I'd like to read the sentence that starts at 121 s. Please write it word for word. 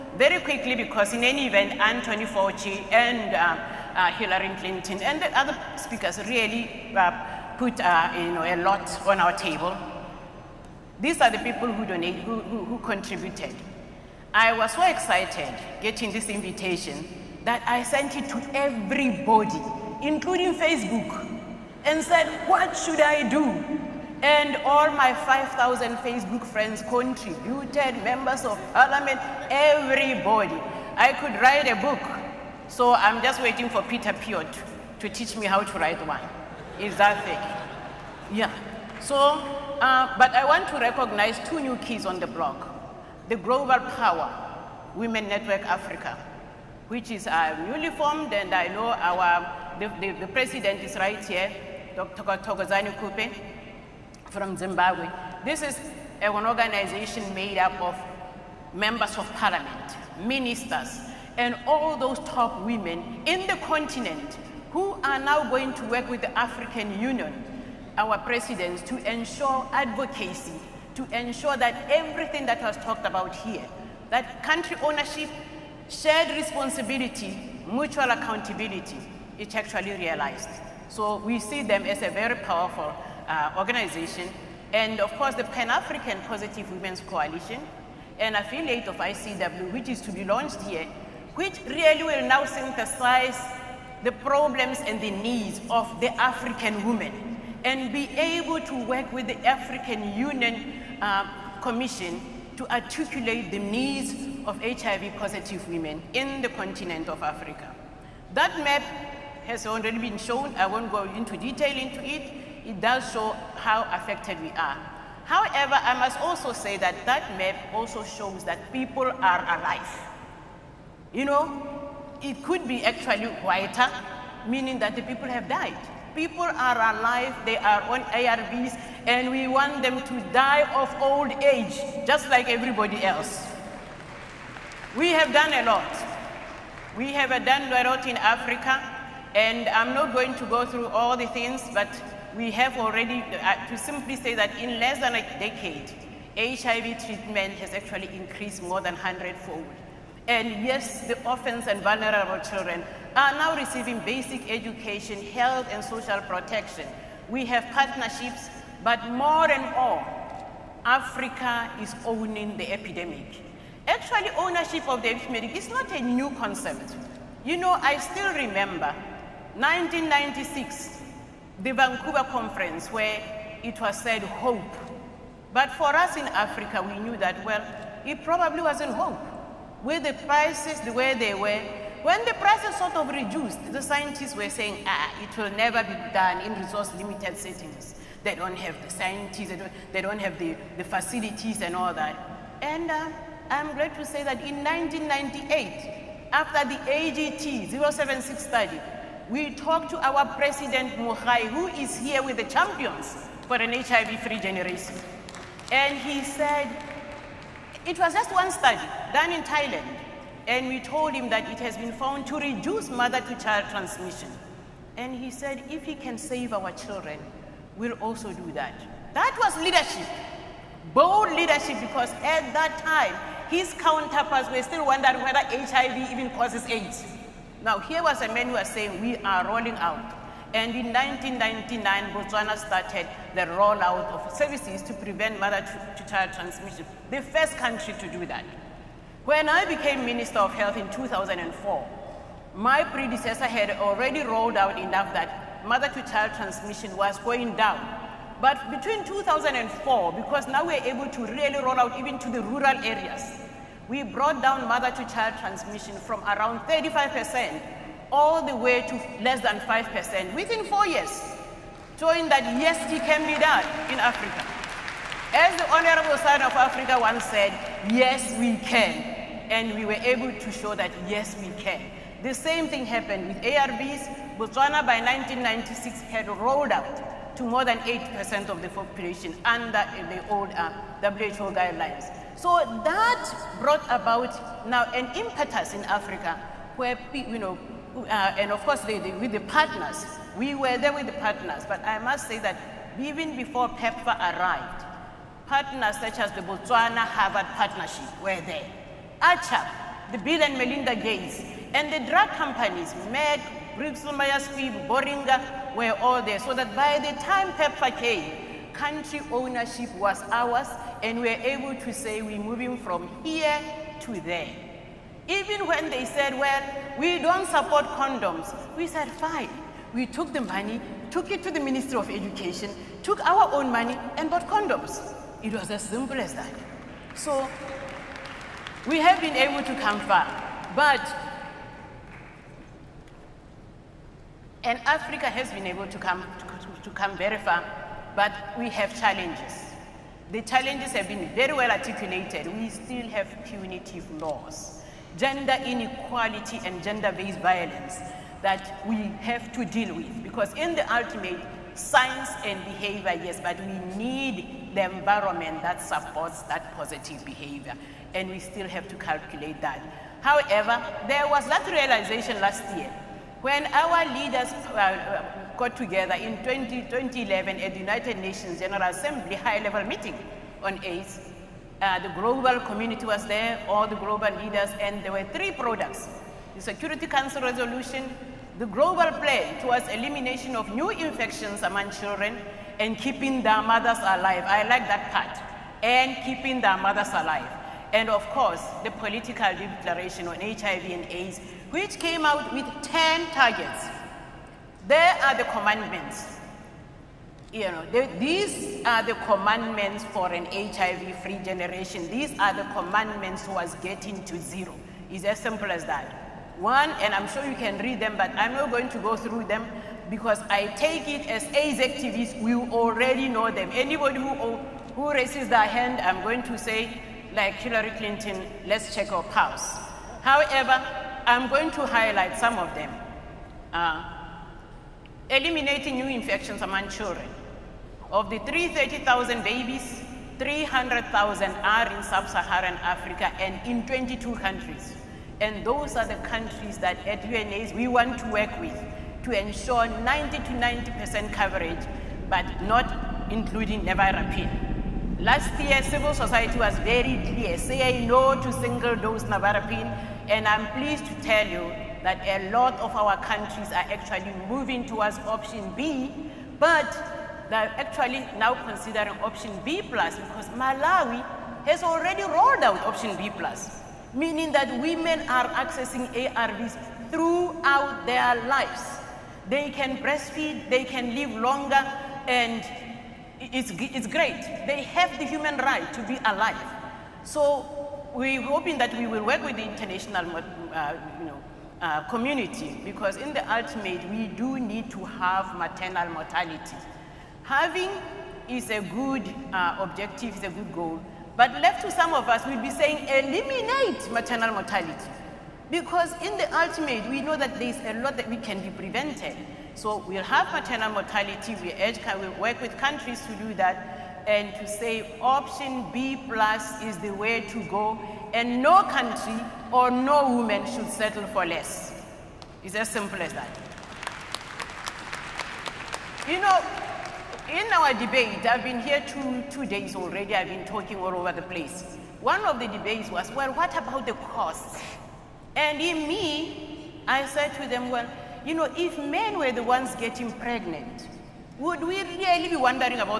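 You know, it could be actually quieter, meaning that the people have died.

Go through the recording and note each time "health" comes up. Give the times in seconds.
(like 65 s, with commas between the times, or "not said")
155 s, 240 s.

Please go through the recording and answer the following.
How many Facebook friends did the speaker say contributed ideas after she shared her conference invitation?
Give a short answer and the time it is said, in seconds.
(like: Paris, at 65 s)
5,000, at 25 s.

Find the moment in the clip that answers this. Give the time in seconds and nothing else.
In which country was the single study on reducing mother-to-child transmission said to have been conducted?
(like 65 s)
209 s.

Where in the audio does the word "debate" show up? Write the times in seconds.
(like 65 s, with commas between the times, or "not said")
517 s, 522 s.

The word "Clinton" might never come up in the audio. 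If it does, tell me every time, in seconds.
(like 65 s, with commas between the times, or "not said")
4 s, 417 s.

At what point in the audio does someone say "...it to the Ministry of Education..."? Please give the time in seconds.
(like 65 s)
321 s.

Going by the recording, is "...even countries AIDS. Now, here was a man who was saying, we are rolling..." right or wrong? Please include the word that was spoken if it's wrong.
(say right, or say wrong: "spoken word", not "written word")
wrong: "causes", not "countries".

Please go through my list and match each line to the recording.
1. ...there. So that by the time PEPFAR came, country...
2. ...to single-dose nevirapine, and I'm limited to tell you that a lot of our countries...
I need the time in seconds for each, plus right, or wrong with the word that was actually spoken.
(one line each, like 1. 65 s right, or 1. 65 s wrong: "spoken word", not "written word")
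1. 306 s right
2. 448 s wrong: "pleased", not "limited".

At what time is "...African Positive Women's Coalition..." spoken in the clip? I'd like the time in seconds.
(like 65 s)
85 s.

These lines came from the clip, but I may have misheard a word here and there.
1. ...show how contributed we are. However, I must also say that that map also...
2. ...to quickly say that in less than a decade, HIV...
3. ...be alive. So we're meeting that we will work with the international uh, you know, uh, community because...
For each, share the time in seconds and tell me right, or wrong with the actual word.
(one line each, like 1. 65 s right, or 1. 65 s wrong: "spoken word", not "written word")
1. 113 s wrong: "affected", not "contributed"
2. 143 s wrong: "simply", not "quickly"
3. 476 s wrong: "hoping", not "meeting".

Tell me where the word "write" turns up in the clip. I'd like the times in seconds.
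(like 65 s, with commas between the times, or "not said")
31 s, 35 s.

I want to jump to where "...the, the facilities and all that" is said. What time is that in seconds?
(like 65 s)
190 s.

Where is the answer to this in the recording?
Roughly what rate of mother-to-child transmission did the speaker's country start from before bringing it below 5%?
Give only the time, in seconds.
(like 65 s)
256 s.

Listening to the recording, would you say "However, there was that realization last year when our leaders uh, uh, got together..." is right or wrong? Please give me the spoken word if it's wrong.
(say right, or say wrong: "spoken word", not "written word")
right.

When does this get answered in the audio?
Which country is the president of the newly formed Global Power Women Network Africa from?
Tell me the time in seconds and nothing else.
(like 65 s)
54 s.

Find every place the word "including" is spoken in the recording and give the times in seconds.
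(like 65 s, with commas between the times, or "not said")
20 s, 443 s.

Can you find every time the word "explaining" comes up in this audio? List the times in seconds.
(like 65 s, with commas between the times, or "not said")
not said.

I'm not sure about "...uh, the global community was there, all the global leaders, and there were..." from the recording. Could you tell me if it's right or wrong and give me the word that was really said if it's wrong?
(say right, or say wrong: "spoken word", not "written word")
right.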